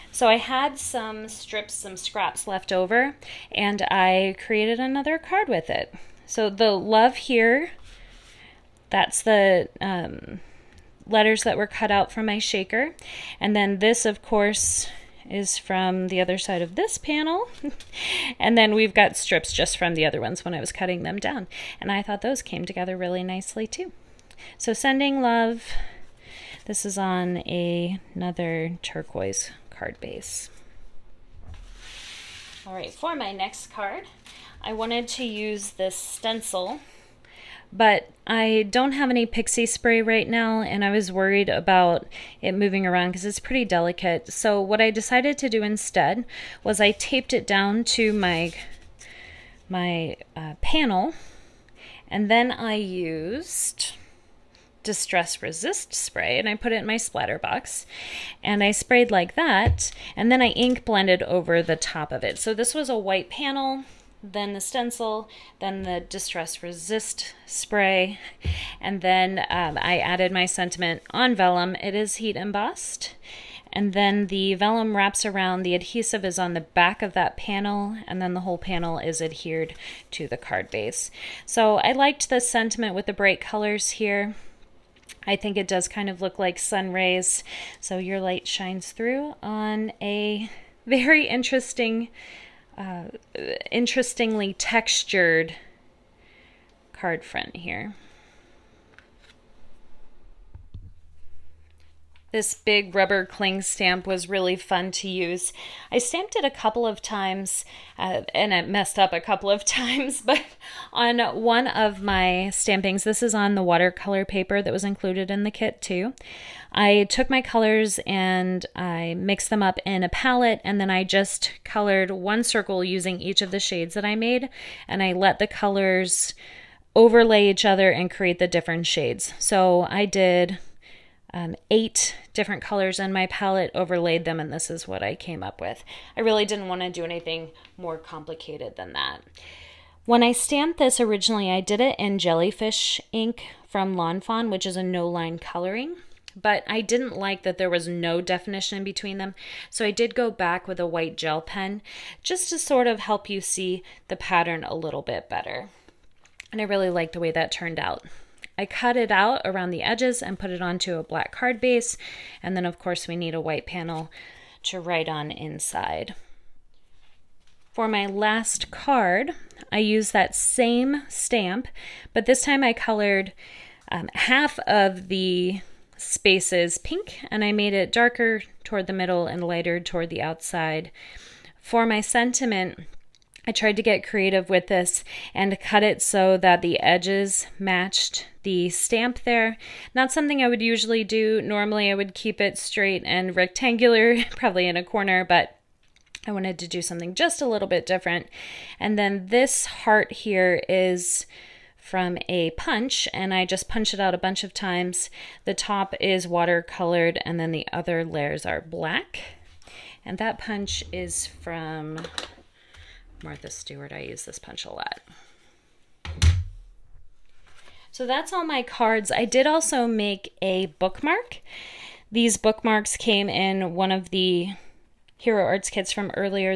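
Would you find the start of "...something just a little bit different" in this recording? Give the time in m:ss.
3:16.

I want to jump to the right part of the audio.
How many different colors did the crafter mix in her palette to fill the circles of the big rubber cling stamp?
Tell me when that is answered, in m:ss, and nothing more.
2:11.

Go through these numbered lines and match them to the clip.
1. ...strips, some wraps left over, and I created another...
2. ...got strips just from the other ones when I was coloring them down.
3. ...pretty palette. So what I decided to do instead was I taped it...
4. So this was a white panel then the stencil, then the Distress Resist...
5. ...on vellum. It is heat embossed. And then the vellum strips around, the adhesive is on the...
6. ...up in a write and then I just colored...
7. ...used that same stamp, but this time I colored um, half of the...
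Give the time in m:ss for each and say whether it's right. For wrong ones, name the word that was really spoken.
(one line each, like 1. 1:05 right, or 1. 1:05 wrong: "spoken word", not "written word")
1. 0:01 wrong: "scraps", not "wraps"
2. 0:18 wrong: "cutting", not "coloring"
3. 0:43 wrong: "delicate", not "palette"
4. 1:02 right
5. 1:11 wrong: "wraps", not "strips"
6. 1:59 wrong: "palette", not "write"
7. 2:49 right.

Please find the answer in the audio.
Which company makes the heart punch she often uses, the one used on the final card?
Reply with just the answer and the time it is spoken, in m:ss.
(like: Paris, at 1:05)
Martha Stewart, at 3:33.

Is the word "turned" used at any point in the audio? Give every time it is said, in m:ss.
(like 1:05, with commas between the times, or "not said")
2:37.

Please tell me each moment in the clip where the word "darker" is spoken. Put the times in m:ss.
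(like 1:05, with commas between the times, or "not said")
2:57.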